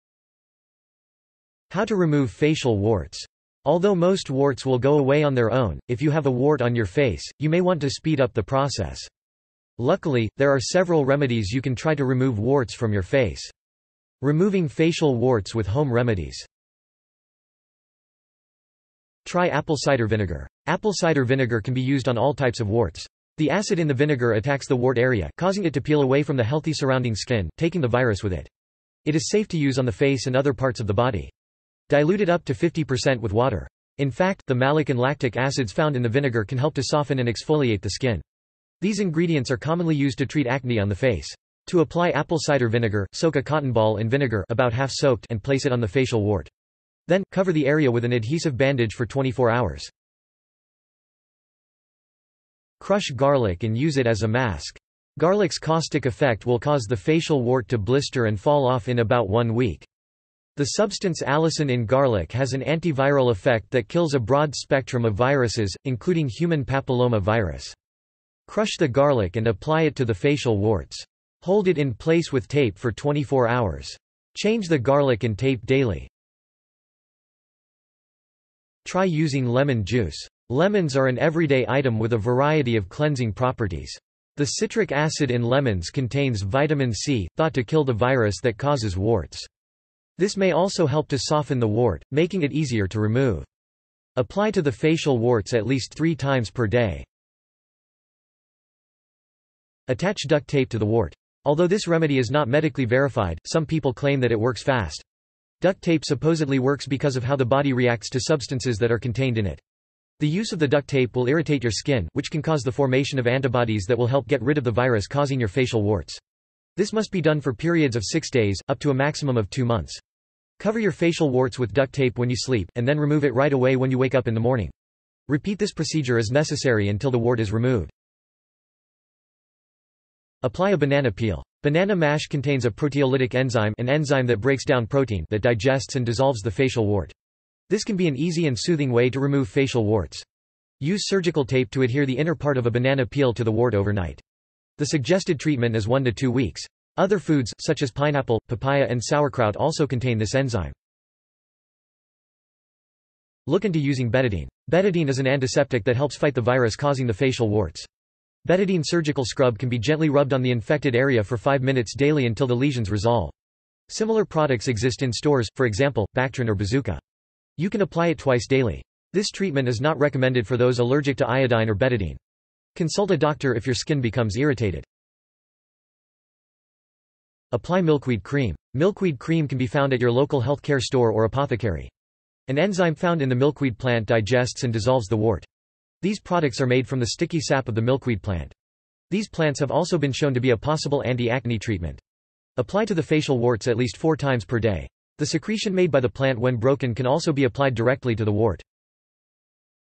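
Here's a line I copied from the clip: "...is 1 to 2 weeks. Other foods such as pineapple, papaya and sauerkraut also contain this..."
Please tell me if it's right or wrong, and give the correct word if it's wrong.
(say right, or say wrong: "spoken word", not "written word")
right.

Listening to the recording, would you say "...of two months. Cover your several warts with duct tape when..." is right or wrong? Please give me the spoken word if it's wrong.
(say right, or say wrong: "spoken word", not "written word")
wrong: "facial", not "several".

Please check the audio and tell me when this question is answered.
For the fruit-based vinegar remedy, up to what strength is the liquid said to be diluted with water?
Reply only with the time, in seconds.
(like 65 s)
32 s.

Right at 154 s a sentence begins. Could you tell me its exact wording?
Betadine is an antiseptic that helps fight the virus causing the facial warts.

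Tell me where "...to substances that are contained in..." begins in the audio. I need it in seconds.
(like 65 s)
108 s.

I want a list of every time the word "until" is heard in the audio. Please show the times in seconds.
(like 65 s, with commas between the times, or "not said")
126 s, 162 s.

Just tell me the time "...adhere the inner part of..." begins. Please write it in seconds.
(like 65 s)
141 s.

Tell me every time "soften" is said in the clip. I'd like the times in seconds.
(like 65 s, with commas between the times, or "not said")
36 s, 91 s.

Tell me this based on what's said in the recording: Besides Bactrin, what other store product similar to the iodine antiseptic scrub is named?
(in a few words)
Bazuka.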